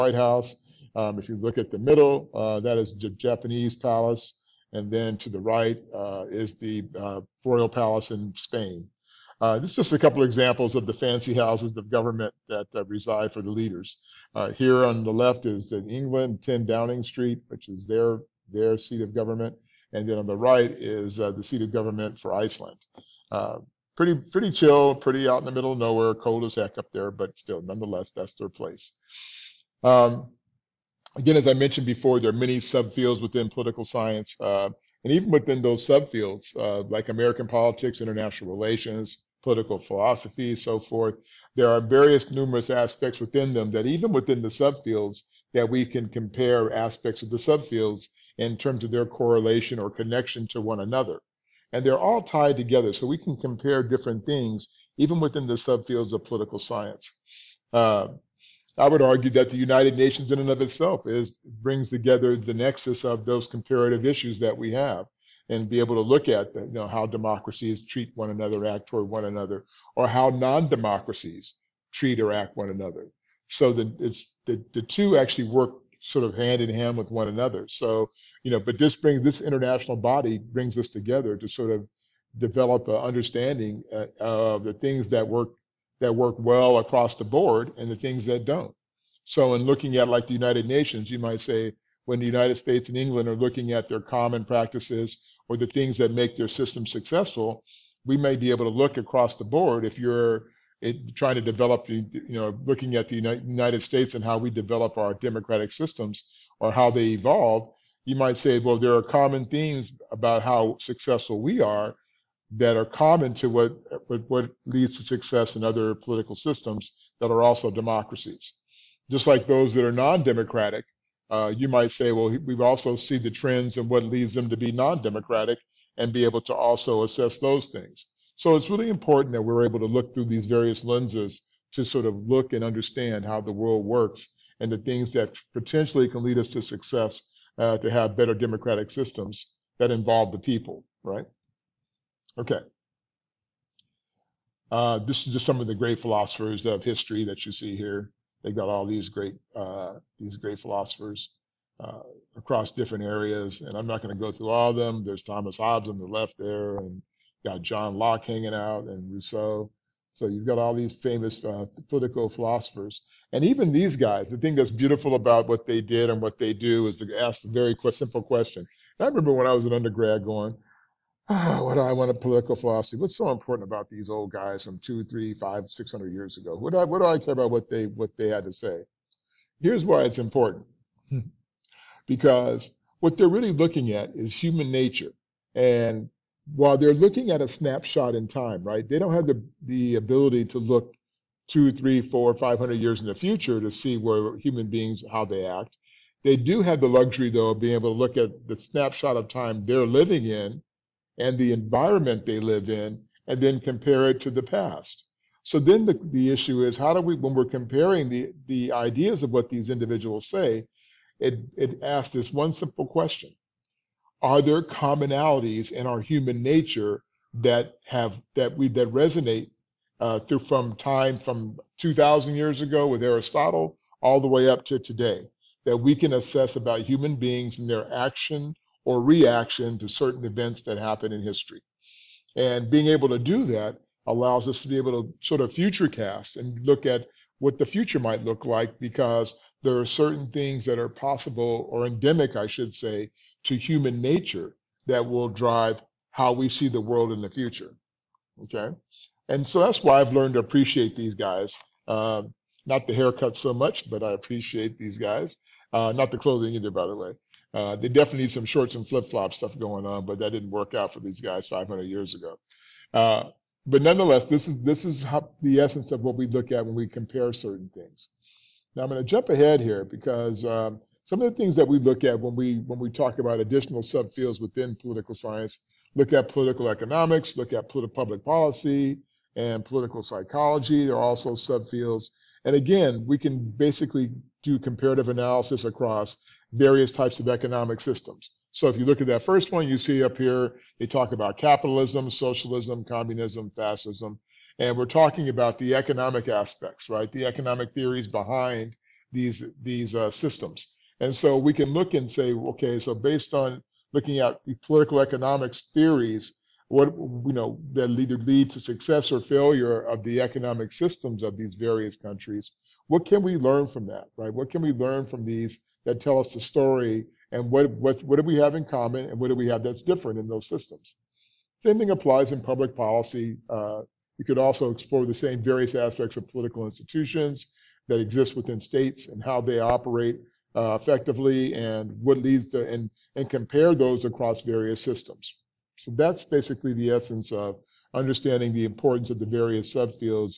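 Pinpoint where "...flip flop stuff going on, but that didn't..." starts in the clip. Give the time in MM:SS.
04:18.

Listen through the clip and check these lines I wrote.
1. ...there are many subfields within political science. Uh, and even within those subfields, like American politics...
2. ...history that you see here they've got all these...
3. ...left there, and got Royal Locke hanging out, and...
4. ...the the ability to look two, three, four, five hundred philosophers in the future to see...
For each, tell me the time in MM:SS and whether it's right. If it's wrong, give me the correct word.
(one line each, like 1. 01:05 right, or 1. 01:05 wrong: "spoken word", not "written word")
1. 00:32 right
2. 02:26 right
3. 02:36 wrong: "John", not "Royal"
4. 03:09 wrong: "years", not "philosophers".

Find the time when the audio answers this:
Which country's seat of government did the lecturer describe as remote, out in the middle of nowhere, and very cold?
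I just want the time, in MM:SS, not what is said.
00:22.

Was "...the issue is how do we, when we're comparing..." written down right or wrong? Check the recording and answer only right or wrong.
right.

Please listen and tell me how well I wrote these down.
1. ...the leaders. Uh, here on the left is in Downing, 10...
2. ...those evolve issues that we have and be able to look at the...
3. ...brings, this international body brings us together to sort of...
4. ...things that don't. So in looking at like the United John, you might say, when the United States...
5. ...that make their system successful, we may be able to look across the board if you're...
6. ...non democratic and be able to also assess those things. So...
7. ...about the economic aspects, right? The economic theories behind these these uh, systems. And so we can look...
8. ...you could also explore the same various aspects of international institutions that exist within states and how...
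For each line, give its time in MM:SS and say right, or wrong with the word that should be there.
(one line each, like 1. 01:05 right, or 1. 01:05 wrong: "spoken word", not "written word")
1. 00:13 wrong: "England", not "Downing"
2. 01:03 wrong: "comparative", not "evolve"
3. 01:18 right
4. 01:27 wrong: "Nations", not "John"
5. 01:35 right
6. 02:04 right
7. 04:55 right
8. 05:24 wrong: "political", not "international".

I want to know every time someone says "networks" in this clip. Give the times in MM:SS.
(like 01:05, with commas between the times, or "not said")
not said.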